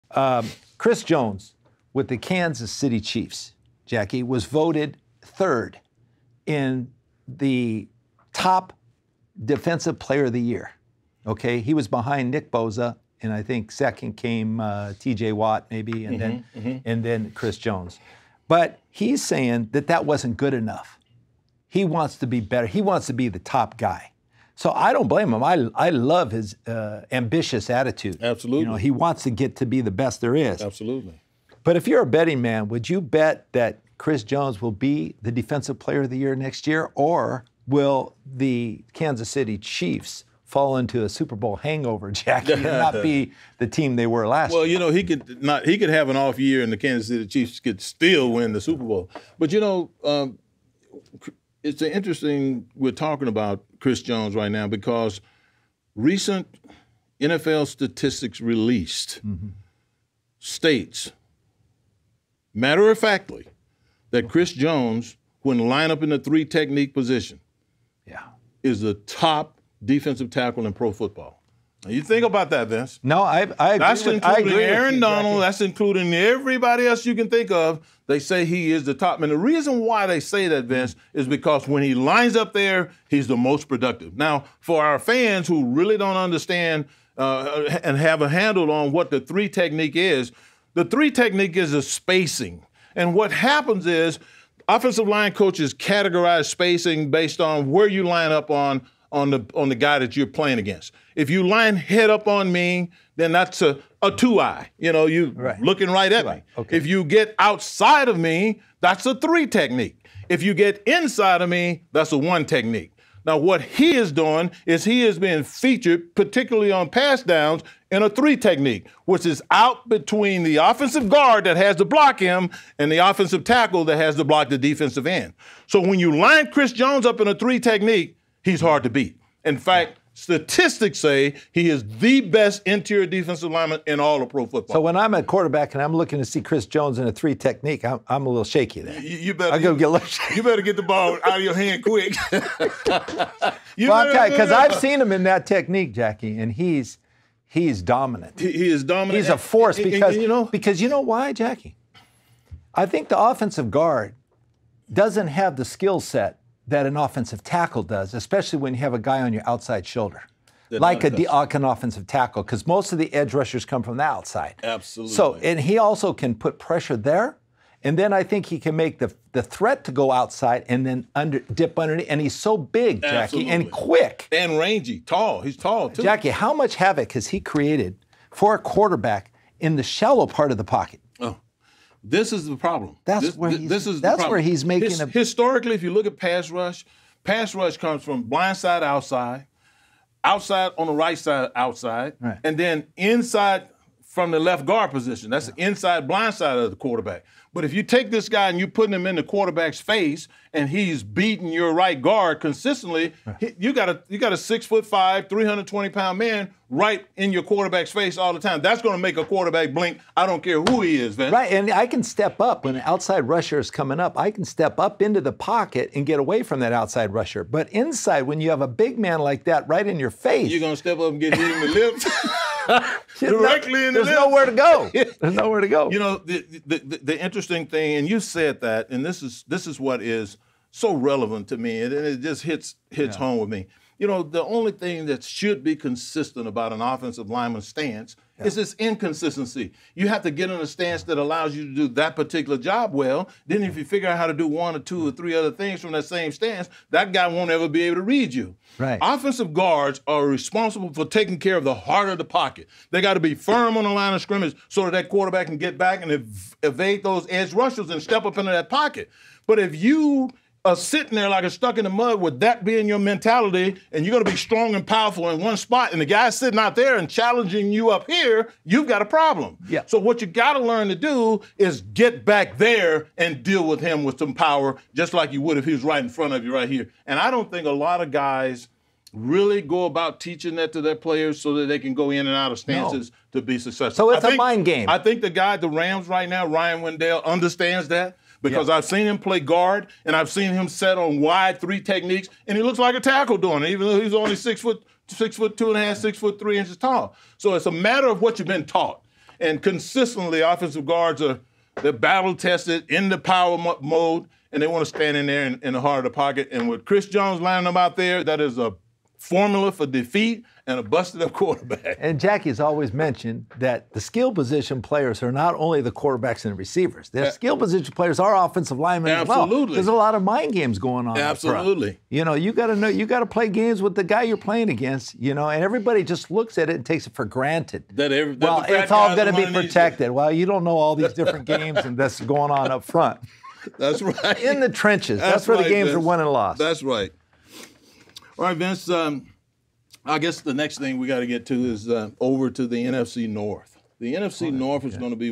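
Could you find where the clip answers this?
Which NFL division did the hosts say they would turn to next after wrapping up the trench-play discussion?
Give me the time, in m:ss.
5:42.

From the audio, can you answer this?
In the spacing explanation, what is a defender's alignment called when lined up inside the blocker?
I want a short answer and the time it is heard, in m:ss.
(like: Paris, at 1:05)
one technique, at 1:52.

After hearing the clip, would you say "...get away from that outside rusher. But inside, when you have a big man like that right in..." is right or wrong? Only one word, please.
right.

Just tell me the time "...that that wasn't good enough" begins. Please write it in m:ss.
0:19.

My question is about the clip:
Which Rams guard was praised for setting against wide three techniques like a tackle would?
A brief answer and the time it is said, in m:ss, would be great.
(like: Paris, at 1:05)
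Ryan Wendell, at 4:46.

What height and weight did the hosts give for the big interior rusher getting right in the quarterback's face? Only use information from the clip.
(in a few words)
6'5", 320 pounds.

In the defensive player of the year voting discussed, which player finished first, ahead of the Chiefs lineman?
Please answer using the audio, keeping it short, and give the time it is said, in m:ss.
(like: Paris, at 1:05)
Nick Bosa, at 0:12.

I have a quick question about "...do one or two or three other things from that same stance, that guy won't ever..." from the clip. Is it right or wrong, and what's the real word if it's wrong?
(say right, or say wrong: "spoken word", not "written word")
right.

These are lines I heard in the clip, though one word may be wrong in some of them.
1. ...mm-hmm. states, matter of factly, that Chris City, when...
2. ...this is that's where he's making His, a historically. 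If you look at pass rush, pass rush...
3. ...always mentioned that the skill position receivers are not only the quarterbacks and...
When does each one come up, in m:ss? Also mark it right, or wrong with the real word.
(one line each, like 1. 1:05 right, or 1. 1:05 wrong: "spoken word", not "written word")
1. 0:59 wrong: "Jones", not "City"
2. 3:03 right
3. 5:12 wrong: "players", not "receivers".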